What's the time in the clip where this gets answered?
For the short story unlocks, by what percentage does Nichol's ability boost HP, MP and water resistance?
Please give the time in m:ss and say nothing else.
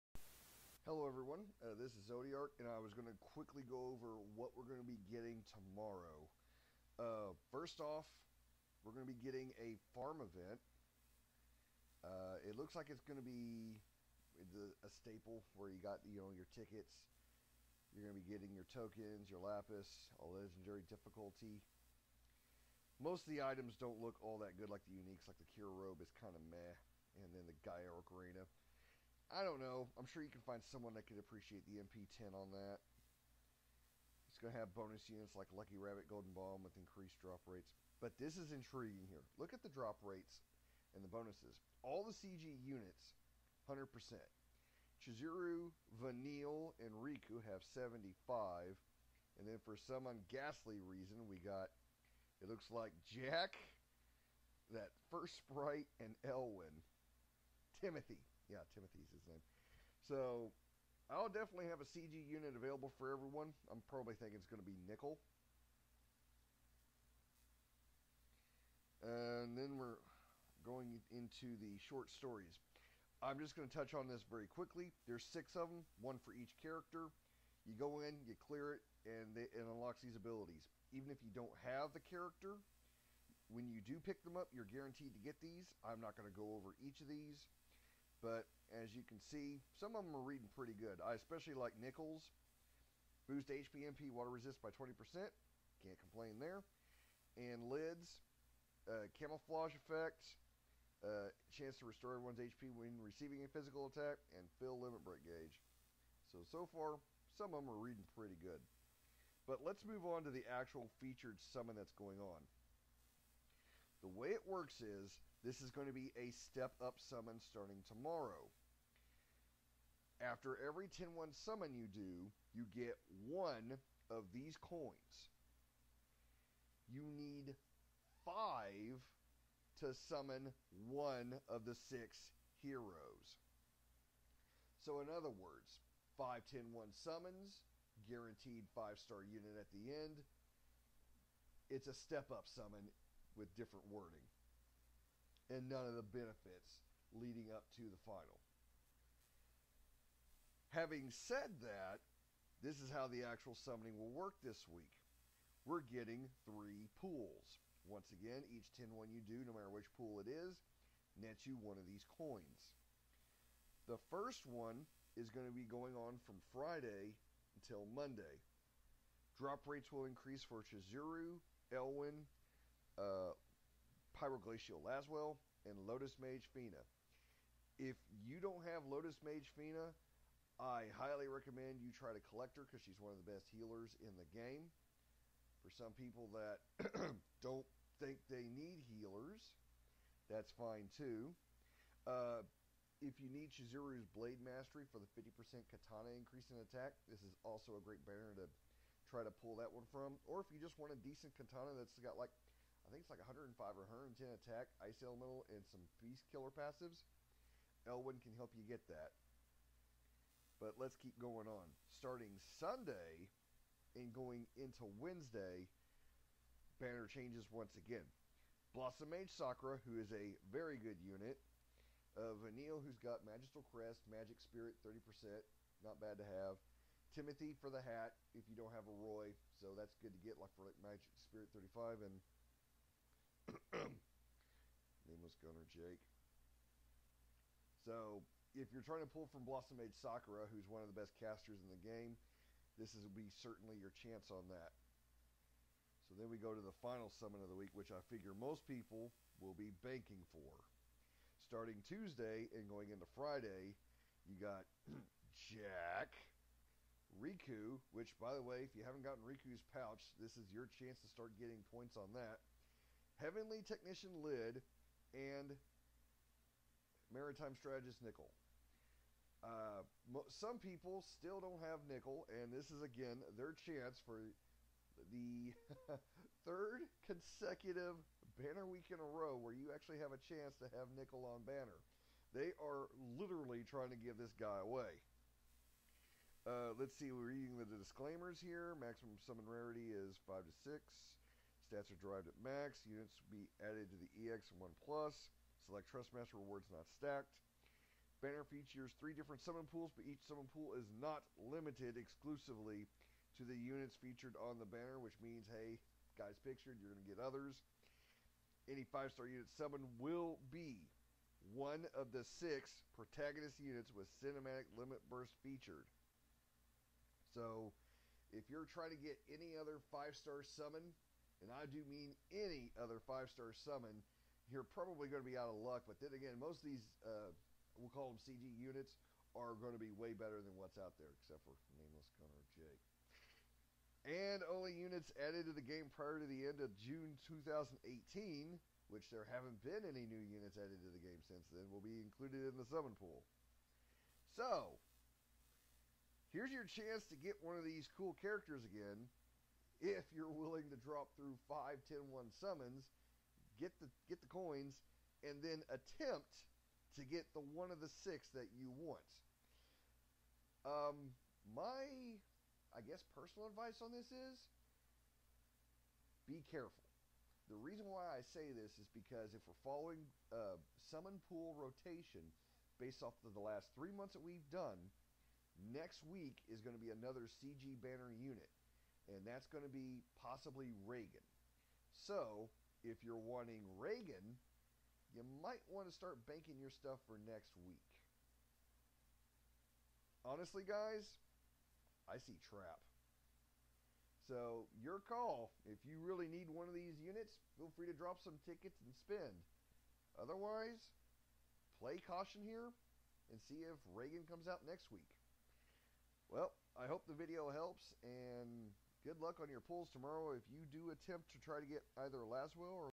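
1:34.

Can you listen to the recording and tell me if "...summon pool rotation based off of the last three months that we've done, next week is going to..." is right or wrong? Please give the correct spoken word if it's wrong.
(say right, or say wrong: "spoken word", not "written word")
right.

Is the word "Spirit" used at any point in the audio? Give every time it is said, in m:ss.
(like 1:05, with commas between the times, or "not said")
3:44, 3:51.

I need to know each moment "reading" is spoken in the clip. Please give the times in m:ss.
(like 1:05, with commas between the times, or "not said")
1:30, 1:47, 4:47.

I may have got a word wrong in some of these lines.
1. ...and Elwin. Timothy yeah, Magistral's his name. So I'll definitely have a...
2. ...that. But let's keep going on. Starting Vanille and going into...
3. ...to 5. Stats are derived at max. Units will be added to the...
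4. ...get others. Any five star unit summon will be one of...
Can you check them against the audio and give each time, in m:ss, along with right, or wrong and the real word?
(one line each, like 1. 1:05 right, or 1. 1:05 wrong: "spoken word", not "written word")
1. 0:56 wrong: "Timothy", not "Magistral"
2. 3:28 wrong: "Sunday", not "Vanille"
3. 4:50 wrong: "6", not "5"
4. 5:07 right.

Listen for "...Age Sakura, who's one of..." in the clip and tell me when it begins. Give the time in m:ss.
3:59.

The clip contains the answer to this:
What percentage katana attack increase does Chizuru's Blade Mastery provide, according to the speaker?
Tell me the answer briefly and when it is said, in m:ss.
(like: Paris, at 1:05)
50%, at 3:15.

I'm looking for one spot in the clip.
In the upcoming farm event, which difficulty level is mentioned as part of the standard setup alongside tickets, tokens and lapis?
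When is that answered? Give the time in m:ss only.
0:20.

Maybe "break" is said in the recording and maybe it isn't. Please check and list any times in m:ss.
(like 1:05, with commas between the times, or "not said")
1:45.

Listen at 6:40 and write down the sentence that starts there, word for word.
Otherwise, play caution here and see if Raegen comes out next week.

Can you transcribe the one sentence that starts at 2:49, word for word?
Drop rates will increase for Chizuru, Elwin uh, Pyroglacial Laswell, and Lotus Mage Fina.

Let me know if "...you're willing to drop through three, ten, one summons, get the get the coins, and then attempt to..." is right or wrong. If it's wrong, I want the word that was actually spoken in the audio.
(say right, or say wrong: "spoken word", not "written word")
wrong: "five", not "three".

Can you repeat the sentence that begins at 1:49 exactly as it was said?
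But let's move on to the actual featured summon that's going on.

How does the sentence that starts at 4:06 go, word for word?
So then we go to the final summon of the week, which I figure most people will be banking for.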